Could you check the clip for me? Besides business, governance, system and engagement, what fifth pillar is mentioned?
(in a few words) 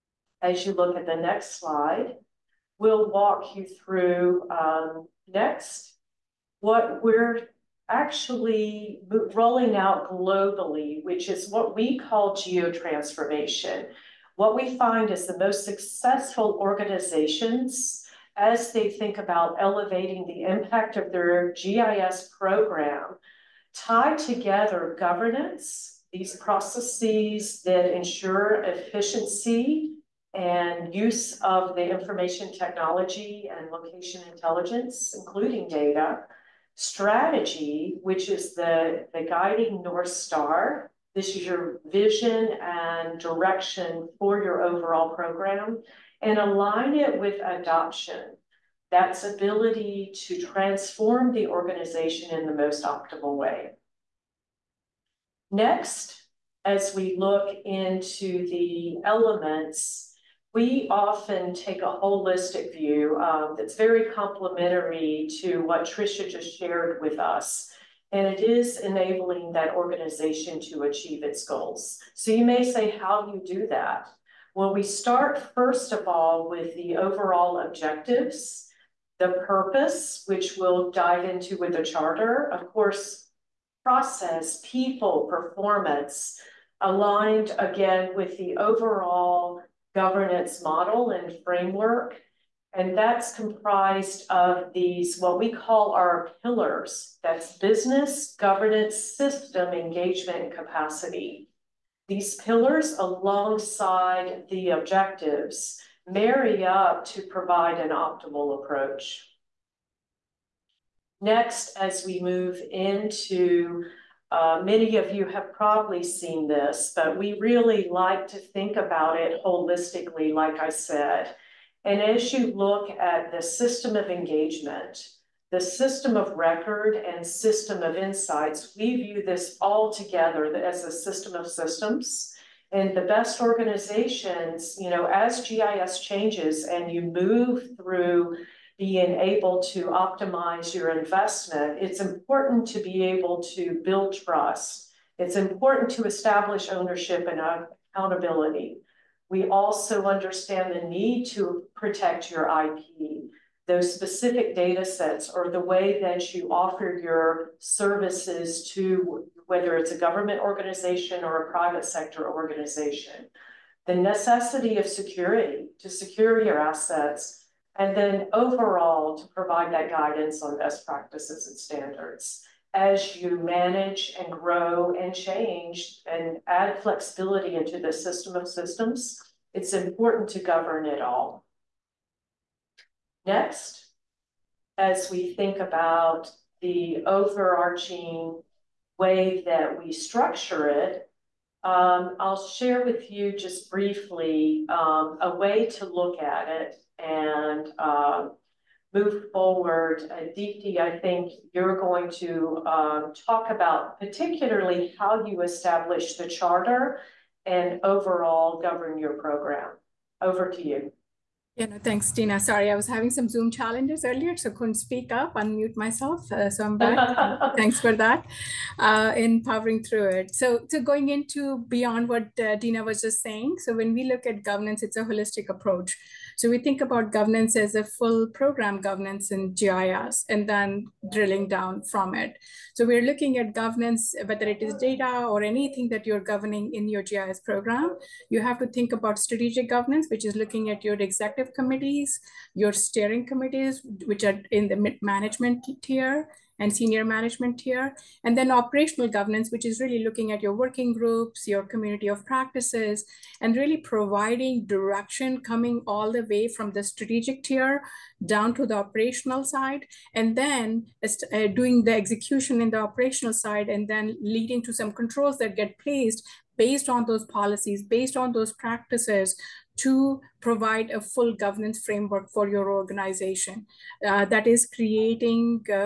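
capacity.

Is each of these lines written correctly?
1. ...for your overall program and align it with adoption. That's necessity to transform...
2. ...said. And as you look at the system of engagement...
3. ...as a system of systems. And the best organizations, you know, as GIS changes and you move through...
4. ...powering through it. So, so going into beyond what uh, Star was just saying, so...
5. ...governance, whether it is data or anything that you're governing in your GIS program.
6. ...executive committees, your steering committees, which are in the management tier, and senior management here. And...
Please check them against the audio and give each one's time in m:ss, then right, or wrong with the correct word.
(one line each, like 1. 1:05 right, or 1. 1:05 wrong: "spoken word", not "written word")
1. 0:44 wrong: "ability", not "necessity"
2. 2:00 right
3. 2:10 right
4. 3:39 wrong: "Dena", not "Star"
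5. 3:53 right
6. 4:00 right.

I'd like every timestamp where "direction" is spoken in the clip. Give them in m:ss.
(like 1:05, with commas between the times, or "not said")
0:43, 4:14.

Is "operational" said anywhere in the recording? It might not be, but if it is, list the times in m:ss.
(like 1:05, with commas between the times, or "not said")
4:08, 4:18, 4:22.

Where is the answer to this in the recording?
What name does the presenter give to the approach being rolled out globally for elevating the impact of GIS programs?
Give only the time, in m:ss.
0:12.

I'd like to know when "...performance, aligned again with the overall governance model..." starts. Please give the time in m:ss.
1:25.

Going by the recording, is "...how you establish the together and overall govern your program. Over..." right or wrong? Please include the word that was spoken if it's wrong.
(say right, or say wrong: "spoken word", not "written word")
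wrong: "charter", not "together".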